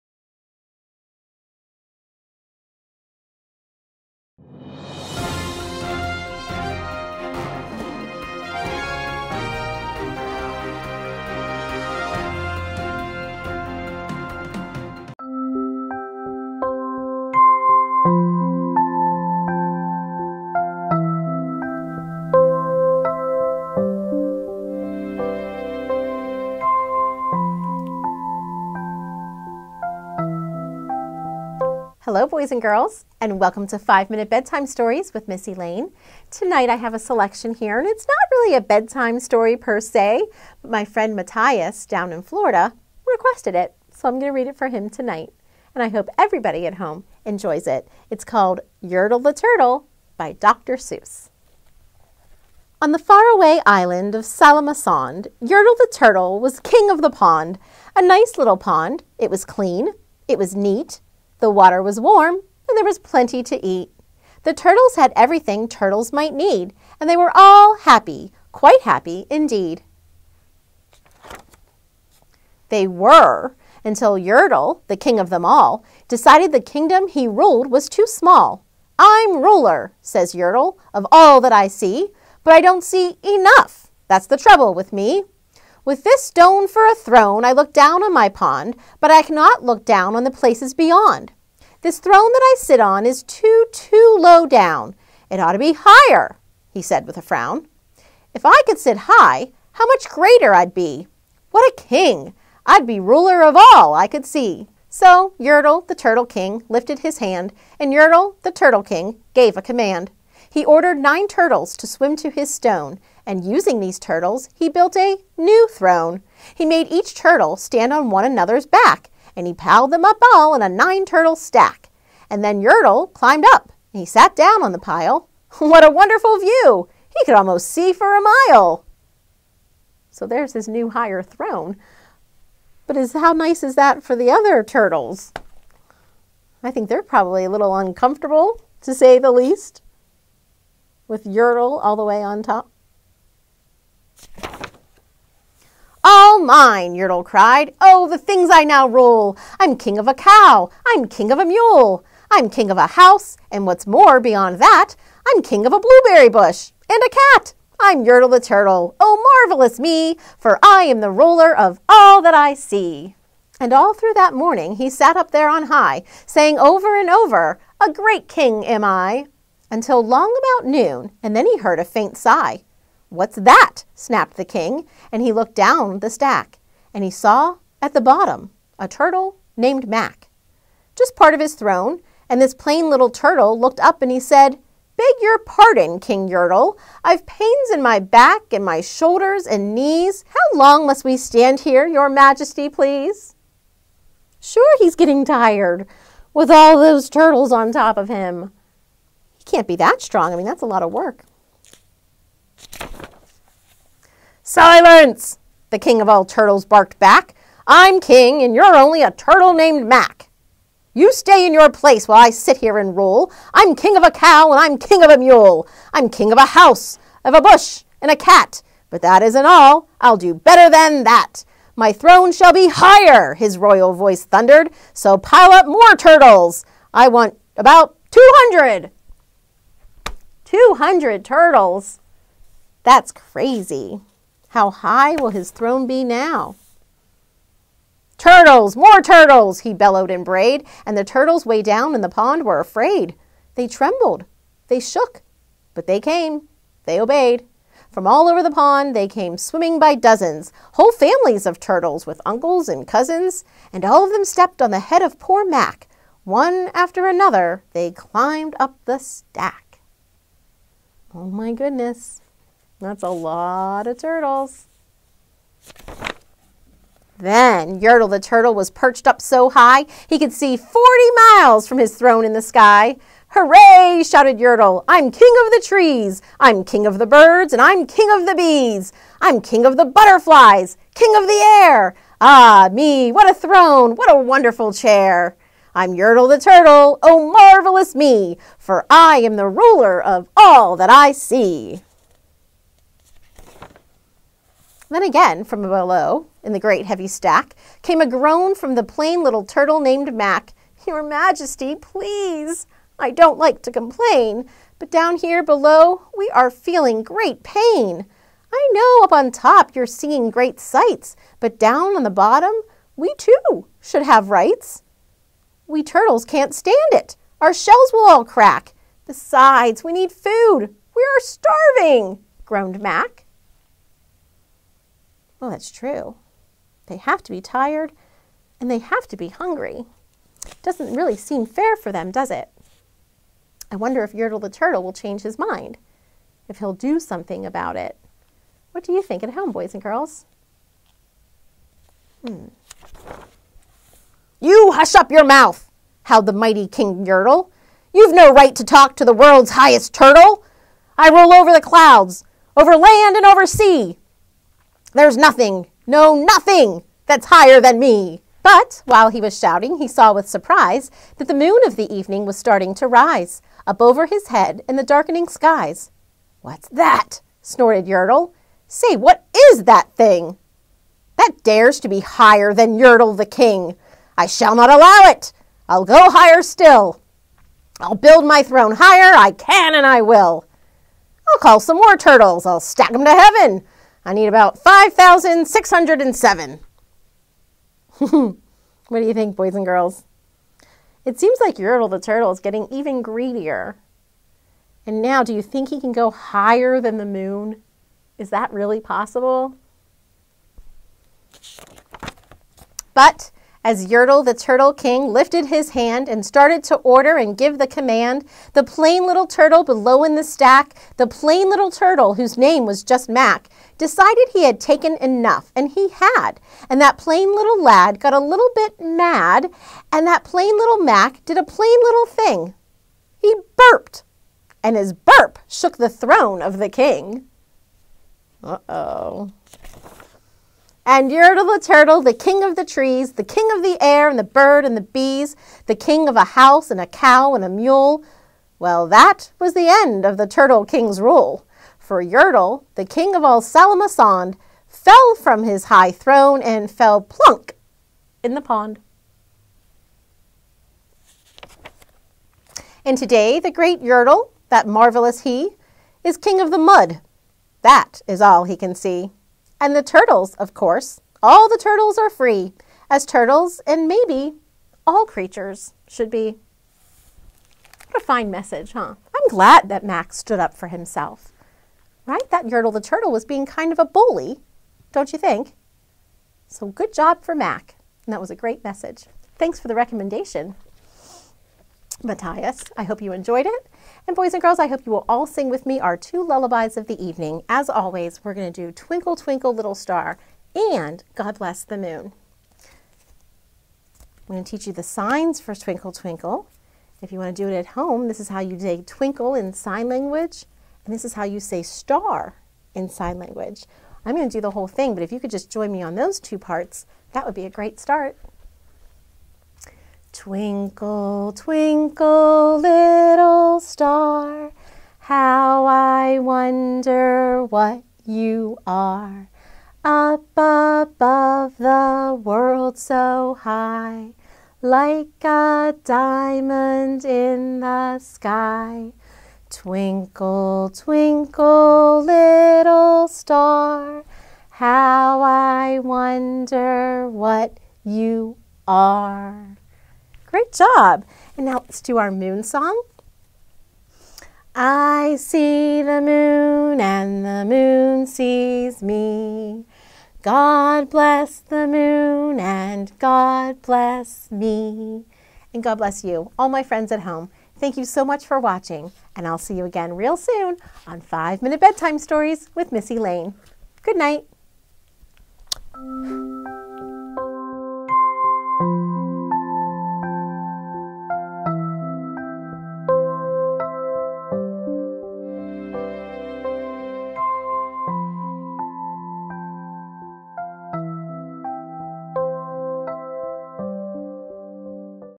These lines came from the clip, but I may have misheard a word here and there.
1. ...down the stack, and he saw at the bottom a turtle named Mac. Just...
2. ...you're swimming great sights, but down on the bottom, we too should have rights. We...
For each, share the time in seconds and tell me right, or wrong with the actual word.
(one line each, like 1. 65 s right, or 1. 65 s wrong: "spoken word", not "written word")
1. 175 s right
2. 309 s wrong: "seeing", not "swimming".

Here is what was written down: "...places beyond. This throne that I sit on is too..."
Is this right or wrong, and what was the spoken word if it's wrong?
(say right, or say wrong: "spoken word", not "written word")
right.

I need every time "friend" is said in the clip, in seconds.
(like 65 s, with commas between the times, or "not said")
40 s, 556 s.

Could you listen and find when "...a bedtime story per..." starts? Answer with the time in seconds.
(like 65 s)
38 s.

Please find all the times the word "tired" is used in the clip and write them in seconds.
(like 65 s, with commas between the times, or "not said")
195 s, 327 s.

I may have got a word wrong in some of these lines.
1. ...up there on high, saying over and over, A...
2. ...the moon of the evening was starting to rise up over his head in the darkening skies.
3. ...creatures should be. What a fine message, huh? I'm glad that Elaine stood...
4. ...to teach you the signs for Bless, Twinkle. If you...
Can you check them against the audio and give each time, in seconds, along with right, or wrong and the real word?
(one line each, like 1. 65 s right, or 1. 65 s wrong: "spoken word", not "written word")
1. 165 s right
2. 361 s right
3. 465 s wrong: "Max", not "Elaine"
4. 494 s wrong: "Twinkle", not "Bless".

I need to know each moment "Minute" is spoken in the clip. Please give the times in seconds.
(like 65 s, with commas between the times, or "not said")
34 s, 561 s.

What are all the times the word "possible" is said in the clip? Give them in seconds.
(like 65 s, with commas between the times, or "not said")
398 s.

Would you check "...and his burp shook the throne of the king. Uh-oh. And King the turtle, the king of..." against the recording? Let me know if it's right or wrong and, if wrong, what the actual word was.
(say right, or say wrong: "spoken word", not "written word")
wrong: "Yertle", not "King".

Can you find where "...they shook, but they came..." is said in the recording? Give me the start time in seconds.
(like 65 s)
244 s.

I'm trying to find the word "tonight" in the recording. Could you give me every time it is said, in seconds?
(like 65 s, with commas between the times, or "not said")
36 s, 44 s.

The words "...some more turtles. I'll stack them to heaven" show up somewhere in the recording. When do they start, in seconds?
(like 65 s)
381 s.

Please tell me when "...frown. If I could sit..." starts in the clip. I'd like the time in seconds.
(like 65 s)
97 s.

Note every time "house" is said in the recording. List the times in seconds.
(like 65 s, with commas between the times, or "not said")
152 s, 216 s, 436 s.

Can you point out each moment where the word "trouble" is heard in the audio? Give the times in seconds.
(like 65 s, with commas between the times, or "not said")
84 s.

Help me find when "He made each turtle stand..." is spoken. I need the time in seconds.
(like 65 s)
116 s.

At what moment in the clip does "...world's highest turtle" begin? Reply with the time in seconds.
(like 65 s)
349 s.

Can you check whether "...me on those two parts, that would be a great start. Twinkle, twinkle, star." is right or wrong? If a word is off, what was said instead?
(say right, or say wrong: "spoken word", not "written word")
right.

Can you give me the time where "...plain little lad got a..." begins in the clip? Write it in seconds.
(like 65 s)
416 s.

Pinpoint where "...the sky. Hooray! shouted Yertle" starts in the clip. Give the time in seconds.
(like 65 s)
272 s.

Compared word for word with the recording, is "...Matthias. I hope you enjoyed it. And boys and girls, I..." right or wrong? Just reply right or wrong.
right.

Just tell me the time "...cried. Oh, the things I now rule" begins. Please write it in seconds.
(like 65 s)
147 s.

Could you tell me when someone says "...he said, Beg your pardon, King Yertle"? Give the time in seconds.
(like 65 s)
184 s.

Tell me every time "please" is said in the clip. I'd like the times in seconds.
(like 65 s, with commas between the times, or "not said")
192 s, 301 s.